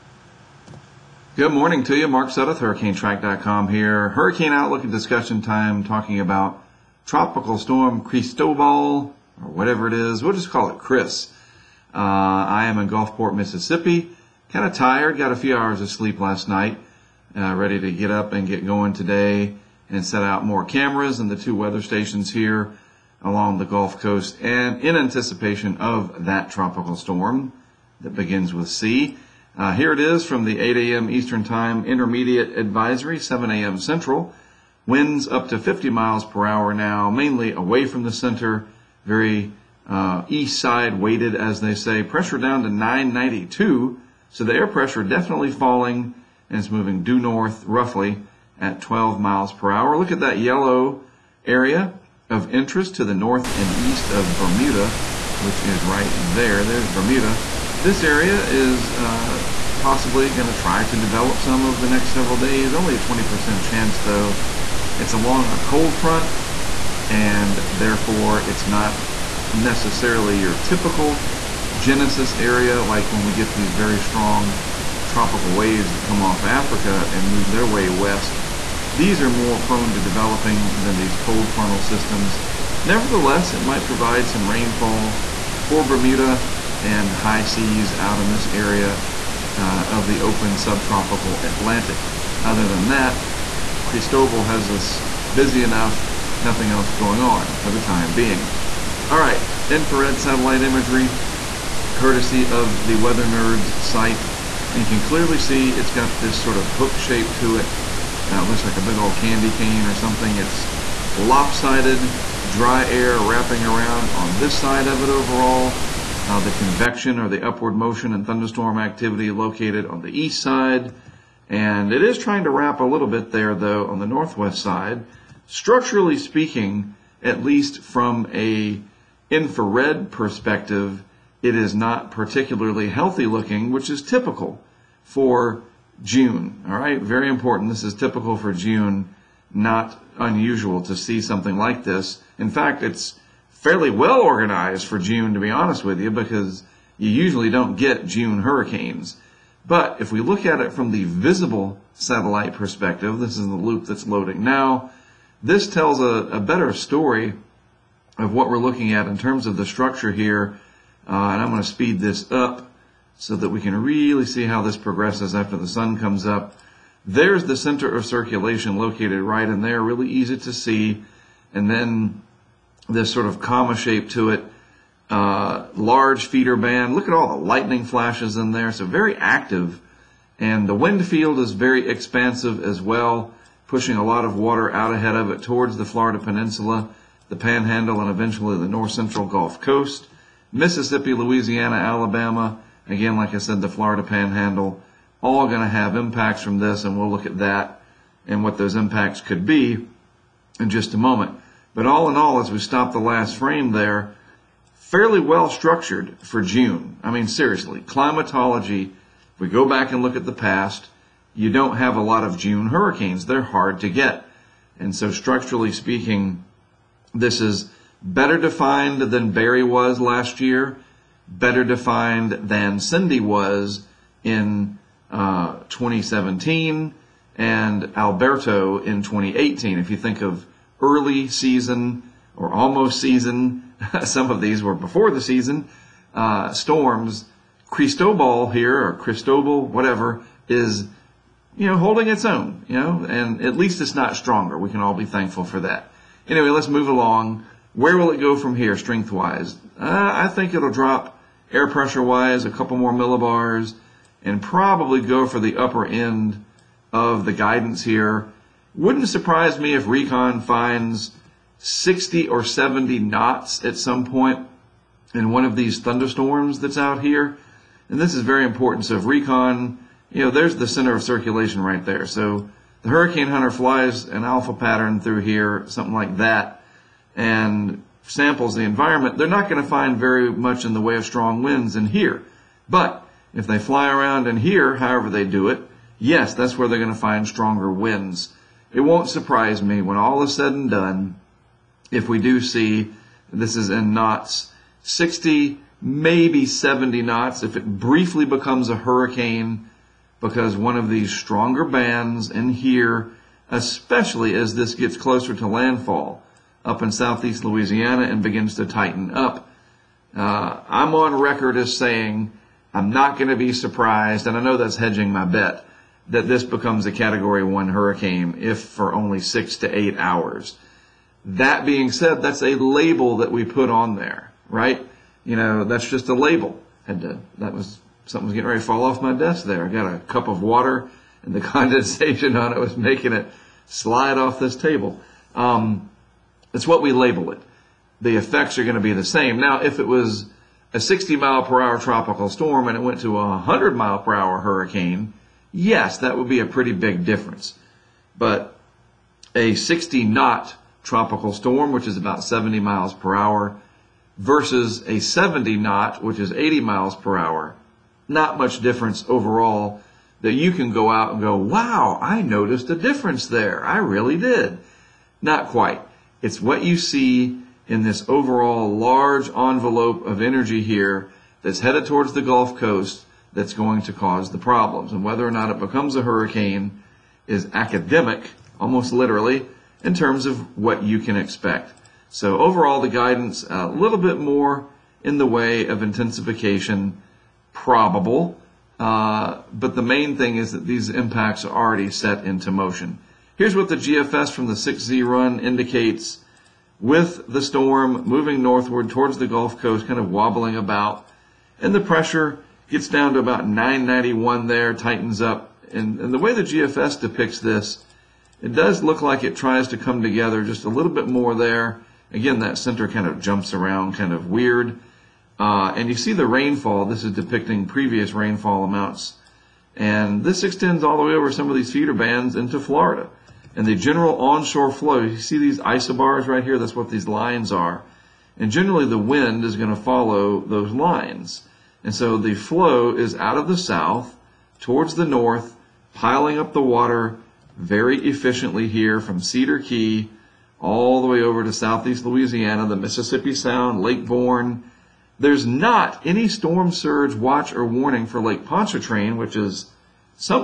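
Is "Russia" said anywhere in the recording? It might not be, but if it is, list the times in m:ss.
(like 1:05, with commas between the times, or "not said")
not said.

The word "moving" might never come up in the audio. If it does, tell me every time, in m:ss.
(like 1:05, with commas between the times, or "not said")
0:46, 6:38.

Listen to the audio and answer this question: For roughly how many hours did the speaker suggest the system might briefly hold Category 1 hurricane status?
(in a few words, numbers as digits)
6 to 8 hours.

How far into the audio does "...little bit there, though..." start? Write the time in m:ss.
2:02.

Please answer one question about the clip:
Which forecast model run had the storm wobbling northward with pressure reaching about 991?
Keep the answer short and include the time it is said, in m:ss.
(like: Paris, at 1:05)
GFS 6Z, at 6:33.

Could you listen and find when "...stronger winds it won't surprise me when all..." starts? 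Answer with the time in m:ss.
4:47.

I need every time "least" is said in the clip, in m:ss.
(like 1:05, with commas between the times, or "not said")
2:07, 4:03.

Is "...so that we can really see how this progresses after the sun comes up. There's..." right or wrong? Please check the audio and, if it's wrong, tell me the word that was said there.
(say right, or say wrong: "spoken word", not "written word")
right.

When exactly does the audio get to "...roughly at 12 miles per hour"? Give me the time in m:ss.
0:47.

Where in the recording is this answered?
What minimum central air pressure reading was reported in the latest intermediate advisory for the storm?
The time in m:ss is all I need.
0:42.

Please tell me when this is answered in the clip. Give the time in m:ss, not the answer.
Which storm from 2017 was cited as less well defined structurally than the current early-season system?
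3:42.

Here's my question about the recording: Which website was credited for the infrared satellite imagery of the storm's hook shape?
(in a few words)
Weather Nerds.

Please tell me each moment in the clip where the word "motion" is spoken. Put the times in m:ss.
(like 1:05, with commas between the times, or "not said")
1:57, 6:32.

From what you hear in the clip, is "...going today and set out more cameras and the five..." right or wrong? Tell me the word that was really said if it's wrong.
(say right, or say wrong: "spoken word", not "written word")
wrong: "two", not "five".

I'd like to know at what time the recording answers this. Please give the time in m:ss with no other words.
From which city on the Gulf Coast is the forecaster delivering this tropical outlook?
0:12.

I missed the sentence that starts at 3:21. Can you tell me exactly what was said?
But all in all, as we stop the last frame there, fairly well structured for June.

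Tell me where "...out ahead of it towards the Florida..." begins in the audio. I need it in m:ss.
3:04.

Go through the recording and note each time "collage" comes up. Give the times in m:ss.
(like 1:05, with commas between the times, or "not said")
not said.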